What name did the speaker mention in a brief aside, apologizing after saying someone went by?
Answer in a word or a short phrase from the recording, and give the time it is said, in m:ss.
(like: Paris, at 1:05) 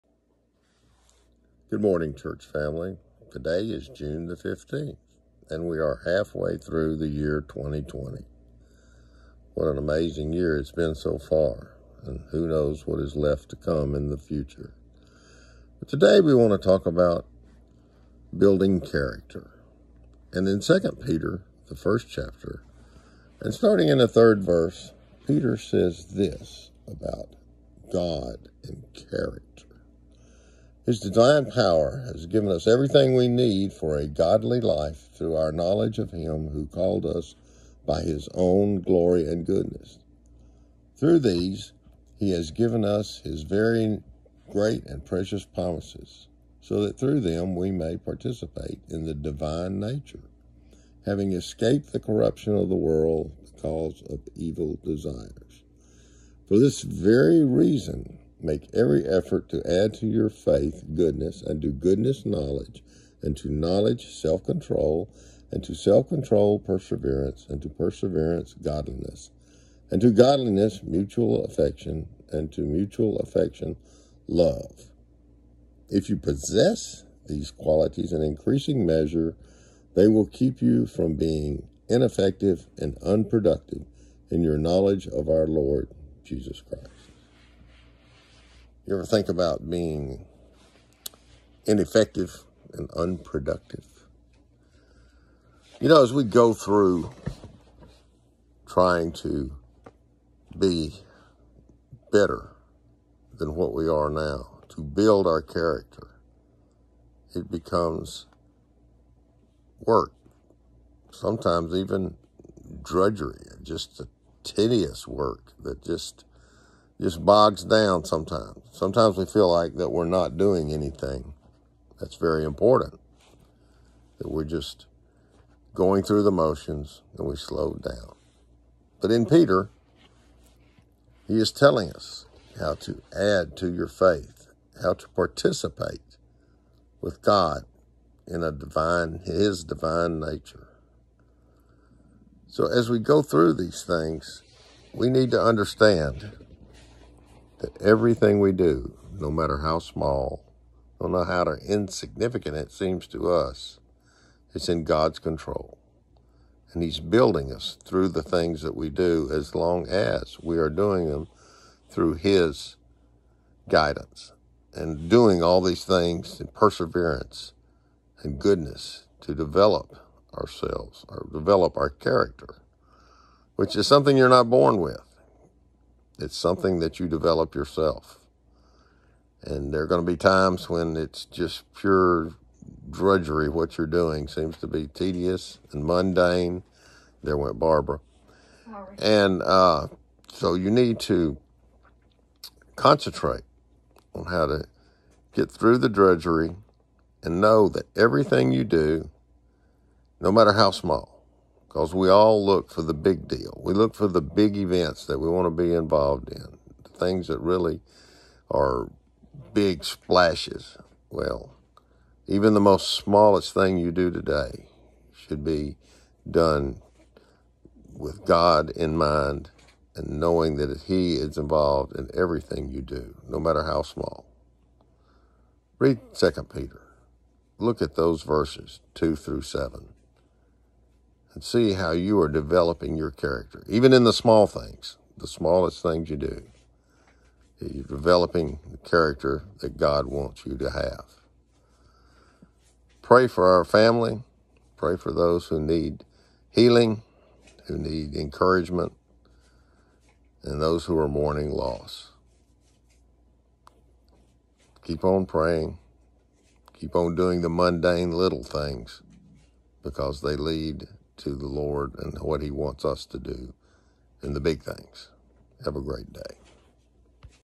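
Barbara, at 3:07.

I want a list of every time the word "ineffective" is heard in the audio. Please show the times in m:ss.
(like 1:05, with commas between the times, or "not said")
1:21, 1:31.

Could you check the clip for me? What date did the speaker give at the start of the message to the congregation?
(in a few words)
June 15th.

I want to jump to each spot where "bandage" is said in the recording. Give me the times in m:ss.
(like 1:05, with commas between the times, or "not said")
not said.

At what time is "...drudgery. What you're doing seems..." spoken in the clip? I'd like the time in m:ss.
3:02.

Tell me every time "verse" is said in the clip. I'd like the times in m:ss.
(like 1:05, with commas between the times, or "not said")
0:24, 3:48.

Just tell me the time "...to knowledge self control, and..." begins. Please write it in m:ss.
1:03.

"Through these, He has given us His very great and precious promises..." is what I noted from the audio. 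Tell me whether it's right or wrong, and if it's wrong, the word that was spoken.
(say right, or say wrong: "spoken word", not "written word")
right.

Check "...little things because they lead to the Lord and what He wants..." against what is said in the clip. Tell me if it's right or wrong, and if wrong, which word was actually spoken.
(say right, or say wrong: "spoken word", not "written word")
right.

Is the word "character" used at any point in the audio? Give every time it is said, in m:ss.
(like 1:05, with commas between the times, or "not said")
0:18, 0:29, 1:45, 2:51, 3:53, 3:58.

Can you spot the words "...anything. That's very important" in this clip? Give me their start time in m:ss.
2:00.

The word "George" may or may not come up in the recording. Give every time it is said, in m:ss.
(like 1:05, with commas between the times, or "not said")
not said.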